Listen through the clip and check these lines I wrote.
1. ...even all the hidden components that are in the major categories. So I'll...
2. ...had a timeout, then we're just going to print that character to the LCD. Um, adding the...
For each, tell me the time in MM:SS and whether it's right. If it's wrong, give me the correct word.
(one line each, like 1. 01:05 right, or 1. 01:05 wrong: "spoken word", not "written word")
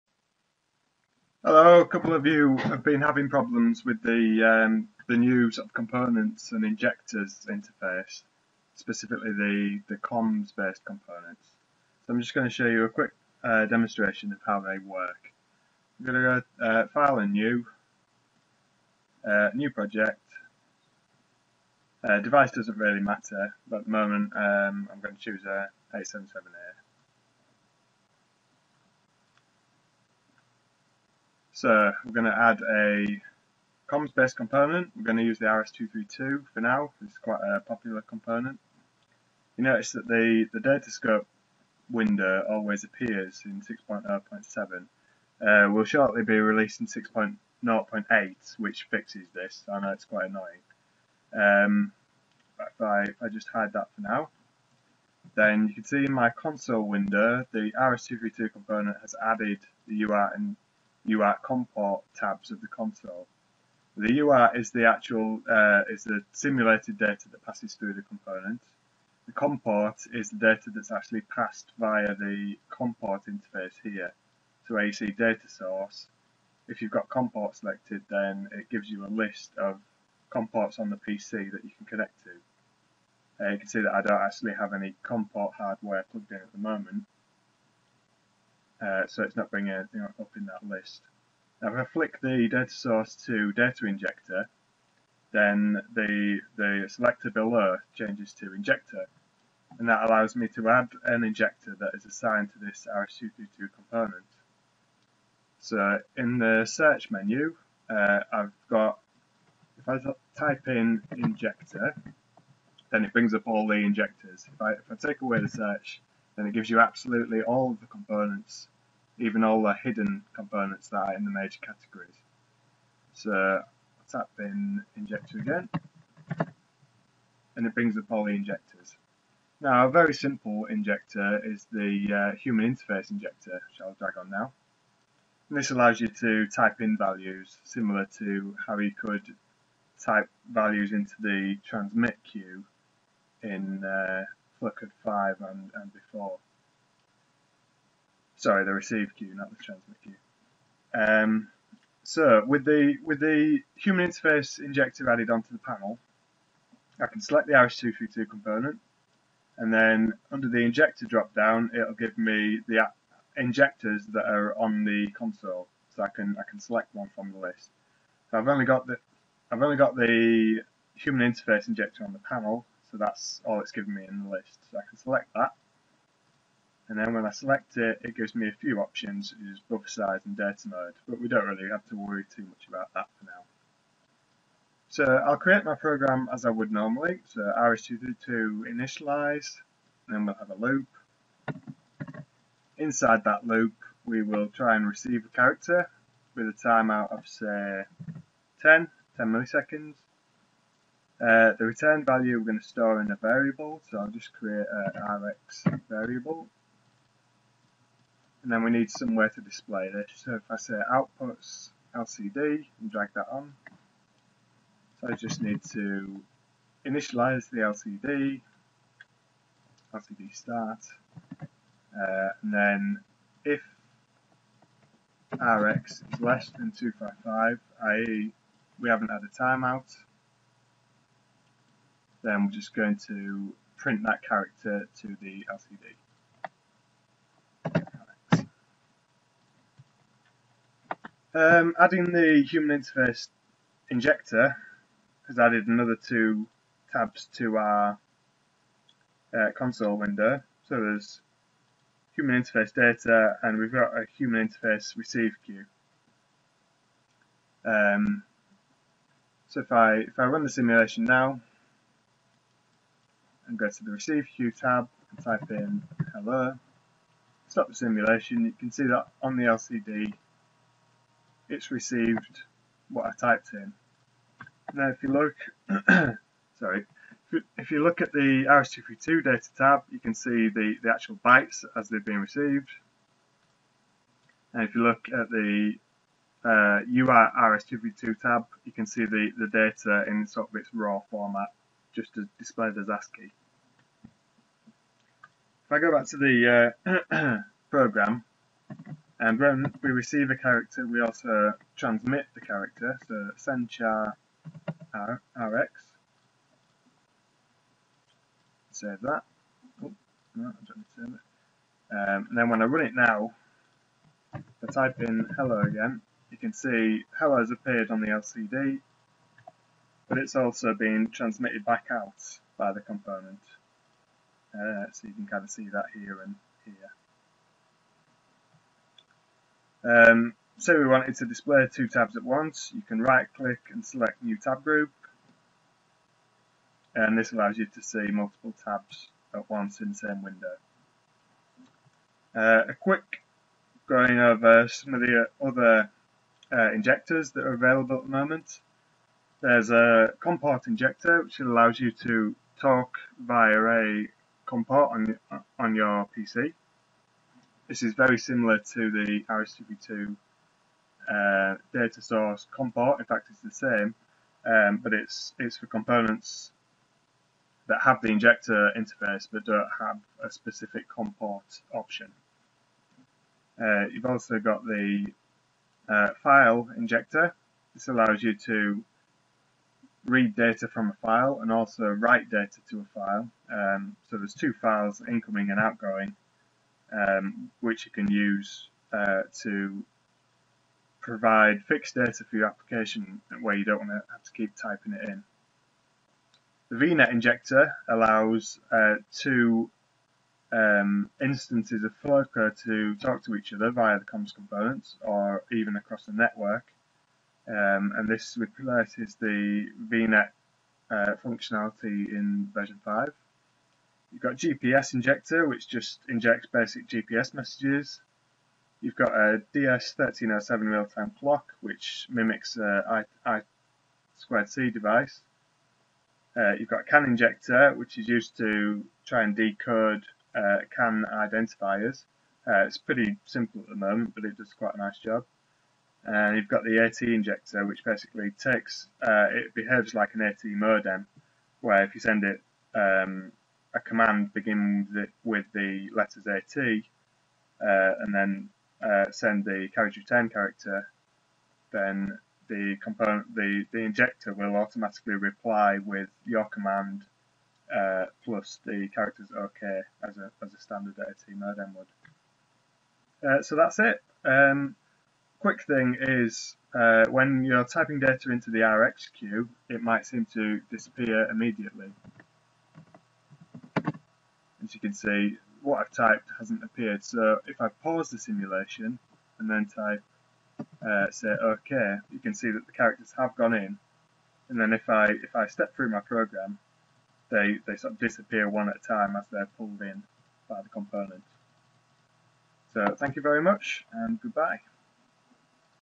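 1. 01:59 right
2. 03:49 right.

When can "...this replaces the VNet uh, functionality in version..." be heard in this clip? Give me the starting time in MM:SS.
06:48.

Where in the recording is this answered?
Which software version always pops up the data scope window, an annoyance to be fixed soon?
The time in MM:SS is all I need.
00:43.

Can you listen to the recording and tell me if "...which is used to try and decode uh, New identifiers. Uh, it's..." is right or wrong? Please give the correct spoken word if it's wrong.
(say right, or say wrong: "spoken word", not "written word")
wrong: "CAN", not "New".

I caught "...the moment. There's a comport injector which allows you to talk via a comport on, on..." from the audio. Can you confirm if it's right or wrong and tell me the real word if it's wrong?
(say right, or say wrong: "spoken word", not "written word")
right.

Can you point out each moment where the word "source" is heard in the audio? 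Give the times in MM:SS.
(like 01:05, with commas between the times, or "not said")
01:15, 01:32, 06:02.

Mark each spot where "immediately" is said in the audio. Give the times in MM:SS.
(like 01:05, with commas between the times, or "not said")
07:51.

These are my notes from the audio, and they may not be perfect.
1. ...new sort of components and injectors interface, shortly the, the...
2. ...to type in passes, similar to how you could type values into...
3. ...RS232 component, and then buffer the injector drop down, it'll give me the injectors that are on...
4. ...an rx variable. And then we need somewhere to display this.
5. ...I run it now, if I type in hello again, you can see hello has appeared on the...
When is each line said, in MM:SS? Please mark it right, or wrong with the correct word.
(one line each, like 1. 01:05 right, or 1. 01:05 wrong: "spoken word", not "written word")
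1. 00:05 wrong: "specifically", not "shortly"
2. 02:16 wrong: "values", not "passes"
3. 02:37 wrong: "under", not "buffer"
4. 03:24 right
5. 05:12 right.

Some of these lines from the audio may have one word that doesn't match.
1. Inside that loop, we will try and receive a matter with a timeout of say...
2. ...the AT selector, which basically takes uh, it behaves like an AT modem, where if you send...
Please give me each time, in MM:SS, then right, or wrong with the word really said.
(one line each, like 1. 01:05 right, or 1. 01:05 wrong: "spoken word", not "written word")
1. 03:12 wrong: "character", not "matter"
2. 07:16 wrong: "injector", not "selector".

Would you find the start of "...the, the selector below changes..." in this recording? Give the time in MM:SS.
01:35.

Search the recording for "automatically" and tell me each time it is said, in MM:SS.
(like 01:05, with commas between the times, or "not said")
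07:34.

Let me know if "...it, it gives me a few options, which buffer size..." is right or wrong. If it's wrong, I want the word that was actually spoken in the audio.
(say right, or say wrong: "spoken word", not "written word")
right.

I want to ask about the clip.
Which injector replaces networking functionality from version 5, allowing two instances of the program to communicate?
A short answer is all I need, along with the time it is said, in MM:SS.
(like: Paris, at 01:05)
VNet injector, at 06:36.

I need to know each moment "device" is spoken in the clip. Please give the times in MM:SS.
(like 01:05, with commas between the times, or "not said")
00:22, 07:04.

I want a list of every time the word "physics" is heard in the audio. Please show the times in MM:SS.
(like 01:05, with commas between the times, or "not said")
not said.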